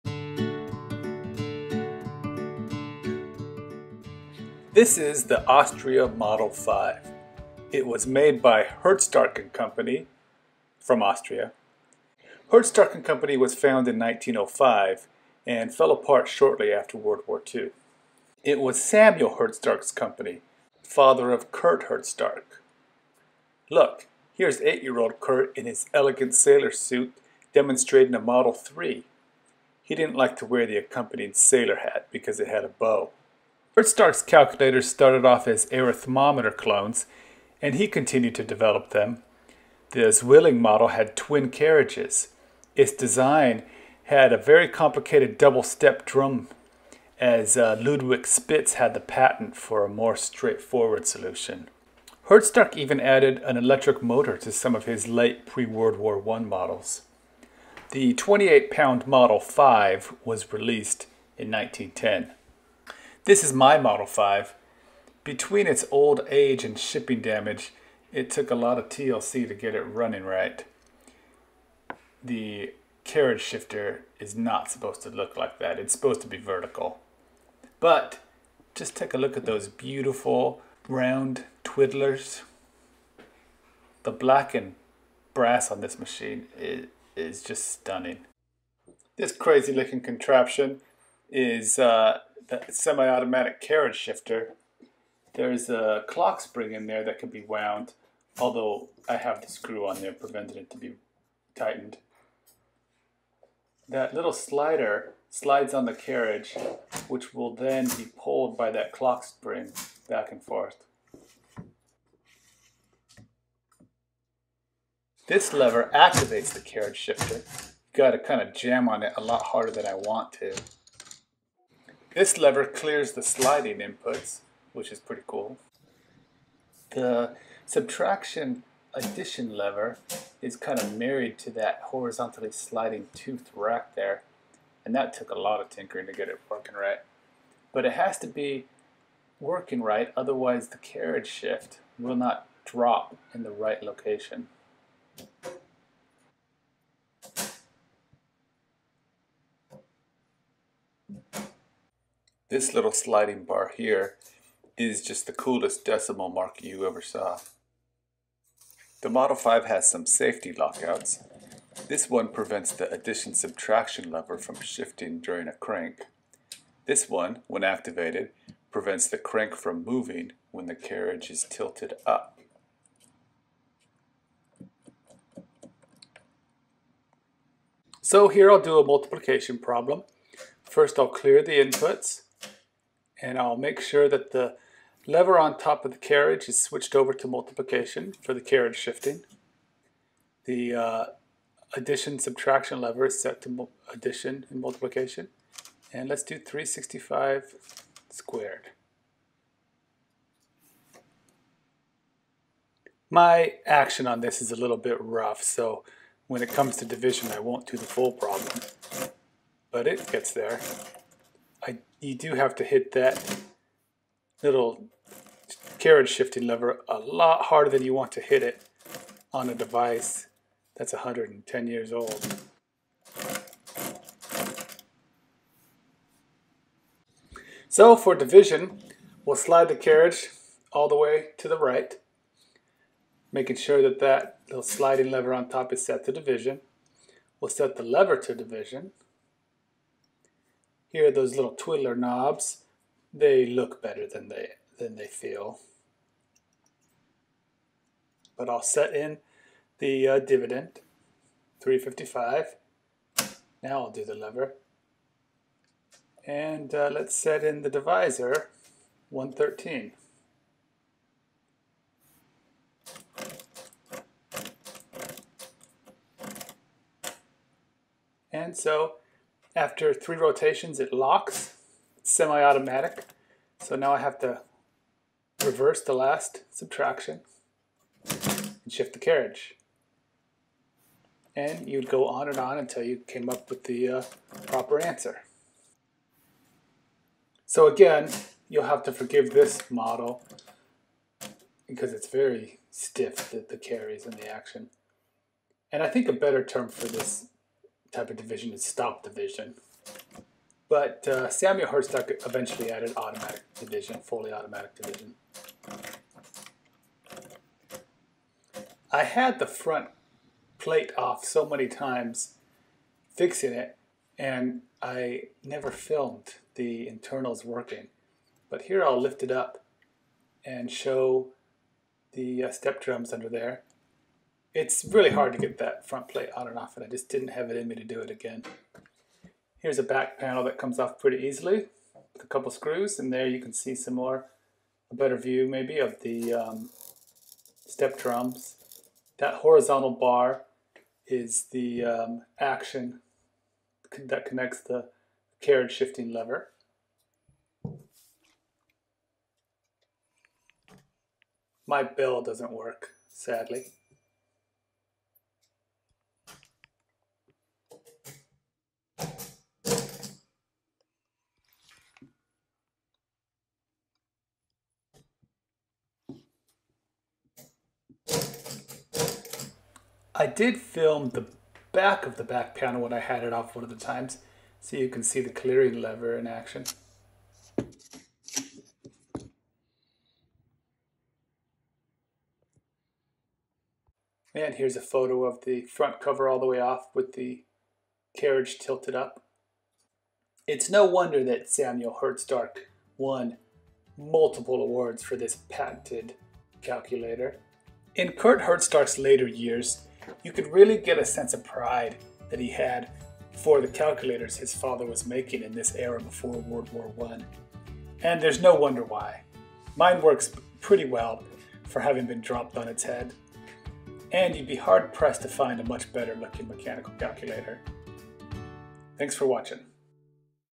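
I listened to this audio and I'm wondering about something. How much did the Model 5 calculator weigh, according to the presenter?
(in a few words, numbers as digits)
28 pounds.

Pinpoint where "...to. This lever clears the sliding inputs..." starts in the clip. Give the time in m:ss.
2:00.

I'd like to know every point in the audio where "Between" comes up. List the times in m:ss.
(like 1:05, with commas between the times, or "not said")
1:05.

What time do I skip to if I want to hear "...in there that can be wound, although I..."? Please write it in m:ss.
1:36.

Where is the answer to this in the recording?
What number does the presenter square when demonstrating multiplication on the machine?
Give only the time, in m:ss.
3:16.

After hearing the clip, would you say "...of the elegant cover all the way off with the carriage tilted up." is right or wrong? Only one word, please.
wrong.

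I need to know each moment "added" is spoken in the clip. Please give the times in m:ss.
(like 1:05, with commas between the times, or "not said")
0:52, 5:02.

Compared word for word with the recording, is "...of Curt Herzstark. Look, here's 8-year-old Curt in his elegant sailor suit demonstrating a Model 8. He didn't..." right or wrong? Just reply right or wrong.
wrong.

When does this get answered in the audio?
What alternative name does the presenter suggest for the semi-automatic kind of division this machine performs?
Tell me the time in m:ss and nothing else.
4:58.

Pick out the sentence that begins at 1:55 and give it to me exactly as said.
This lever activates the carriage shifter.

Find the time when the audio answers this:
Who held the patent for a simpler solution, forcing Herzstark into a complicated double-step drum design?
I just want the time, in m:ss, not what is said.
0:47.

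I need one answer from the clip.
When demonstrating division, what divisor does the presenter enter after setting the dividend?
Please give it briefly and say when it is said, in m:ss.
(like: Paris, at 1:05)
113, at 4:19.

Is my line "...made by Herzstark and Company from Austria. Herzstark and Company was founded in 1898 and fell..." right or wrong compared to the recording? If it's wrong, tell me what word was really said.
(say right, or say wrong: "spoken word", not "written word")
wrong: "1905", not "1898".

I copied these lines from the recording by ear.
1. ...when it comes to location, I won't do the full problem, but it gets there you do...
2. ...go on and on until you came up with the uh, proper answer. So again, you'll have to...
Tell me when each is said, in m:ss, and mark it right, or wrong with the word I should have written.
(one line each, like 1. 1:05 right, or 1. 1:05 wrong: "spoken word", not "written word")
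1. 3:26 wrong: "division", not "location"
2. 4:41 right.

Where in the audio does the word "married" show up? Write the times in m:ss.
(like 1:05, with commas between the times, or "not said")
2:10.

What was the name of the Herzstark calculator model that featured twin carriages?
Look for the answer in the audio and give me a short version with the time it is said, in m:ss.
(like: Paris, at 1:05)
Zwilling, at 0:40.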